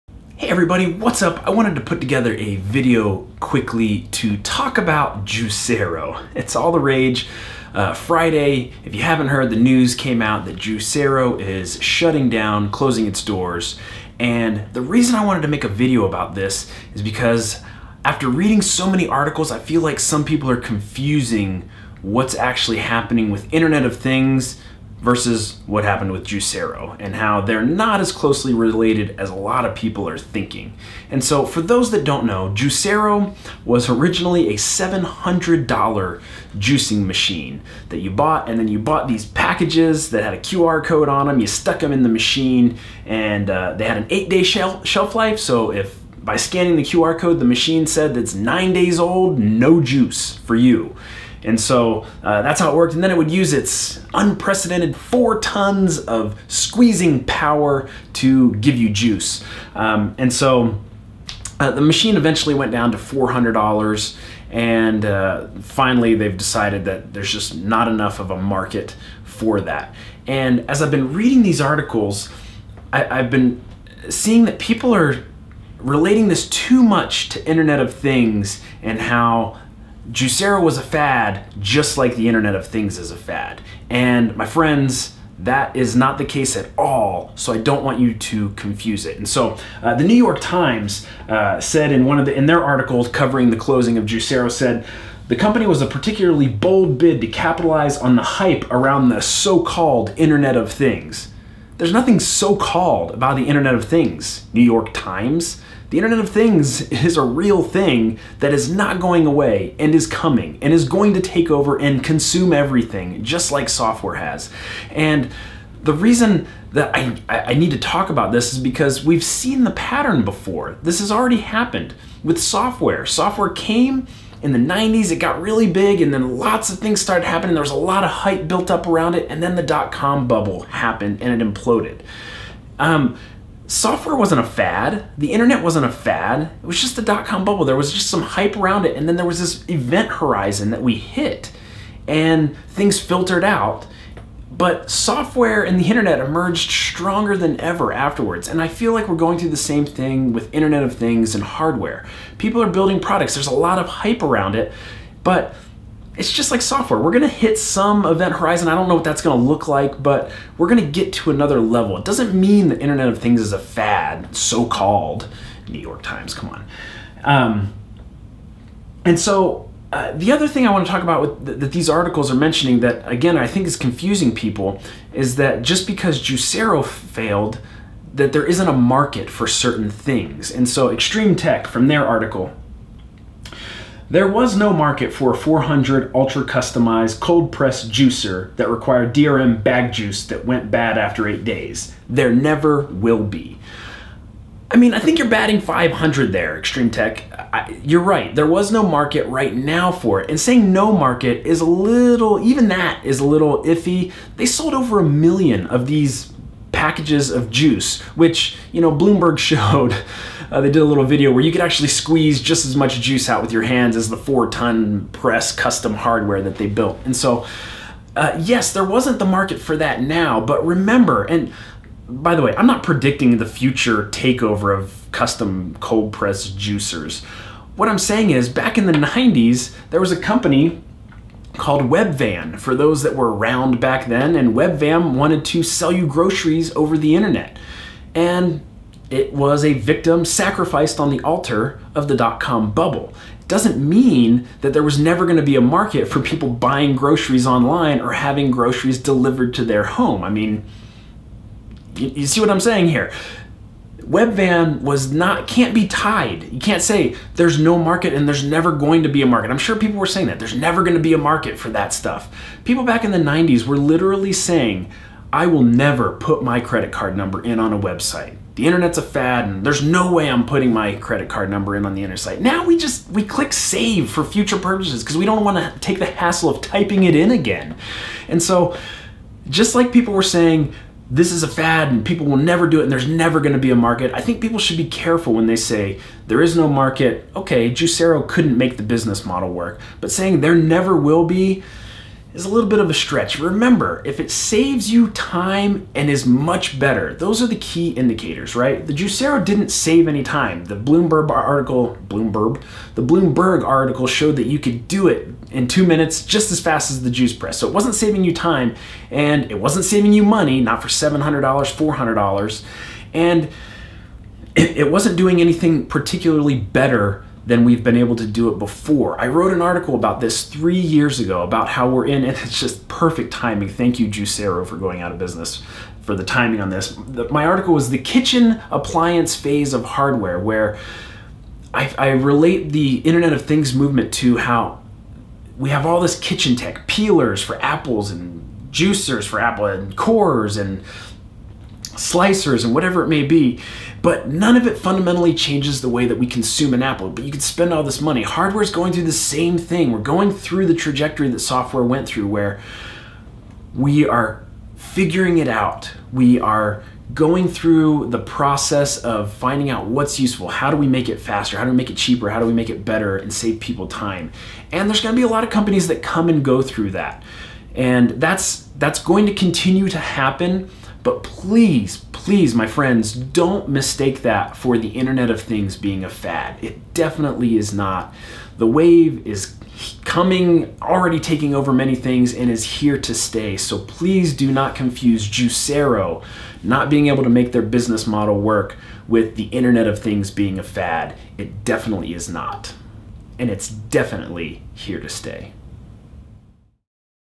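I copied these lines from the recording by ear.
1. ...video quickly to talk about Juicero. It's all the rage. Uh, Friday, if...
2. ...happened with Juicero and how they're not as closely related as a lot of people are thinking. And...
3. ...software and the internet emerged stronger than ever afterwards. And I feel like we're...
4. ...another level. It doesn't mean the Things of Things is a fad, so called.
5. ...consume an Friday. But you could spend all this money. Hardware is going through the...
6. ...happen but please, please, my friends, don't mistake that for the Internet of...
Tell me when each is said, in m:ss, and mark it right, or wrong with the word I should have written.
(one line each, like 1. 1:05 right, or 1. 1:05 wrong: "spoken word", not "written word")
1. 0:02 right
2. 0:25 right
3. 2:24 right
4. 2:41 wrong: "Internet", not "Things"
5. 5:46 wrong: "Apple", not "Friday"
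6. 6:09 right.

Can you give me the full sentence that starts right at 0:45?
So, if by scanning the QR code, the machine said that's nine days old, no juice for you.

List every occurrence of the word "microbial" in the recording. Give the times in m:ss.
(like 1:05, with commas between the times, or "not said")
not said.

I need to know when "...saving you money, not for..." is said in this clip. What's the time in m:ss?
5:09.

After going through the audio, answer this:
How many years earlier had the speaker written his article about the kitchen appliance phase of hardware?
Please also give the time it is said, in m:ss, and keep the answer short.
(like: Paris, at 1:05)
3 years, at 5:20.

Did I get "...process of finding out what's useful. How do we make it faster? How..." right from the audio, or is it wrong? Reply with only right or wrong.
right.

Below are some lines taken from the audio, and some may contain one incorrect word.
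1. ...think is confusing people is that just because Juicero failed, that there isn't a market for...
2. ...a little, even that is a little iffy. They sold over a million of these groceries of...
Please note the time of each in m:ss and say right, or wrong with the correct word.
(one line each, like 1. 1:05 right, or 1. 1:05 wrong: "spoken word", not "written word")
1. 2:53 right
2. 3:21 wrong: "packages", not "groceries".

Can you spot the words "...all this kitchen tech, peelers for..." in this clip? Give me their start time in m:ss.
5:35.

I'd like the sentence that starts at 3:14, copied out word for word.
I mean, I think you're batting 500 there, Extreme Tech.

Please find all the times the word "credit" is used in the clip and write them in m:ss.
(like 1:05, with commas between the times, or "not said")
4:26, 4:30.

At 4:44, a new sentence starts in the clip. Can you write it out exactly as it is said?
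I think people should be careful when they say there is no market.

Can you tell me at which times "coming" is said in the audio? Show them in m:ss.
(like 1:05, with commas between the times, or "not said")
1:50, 6:20.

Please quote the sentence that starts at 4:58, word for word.
The Juicero didn't save any time.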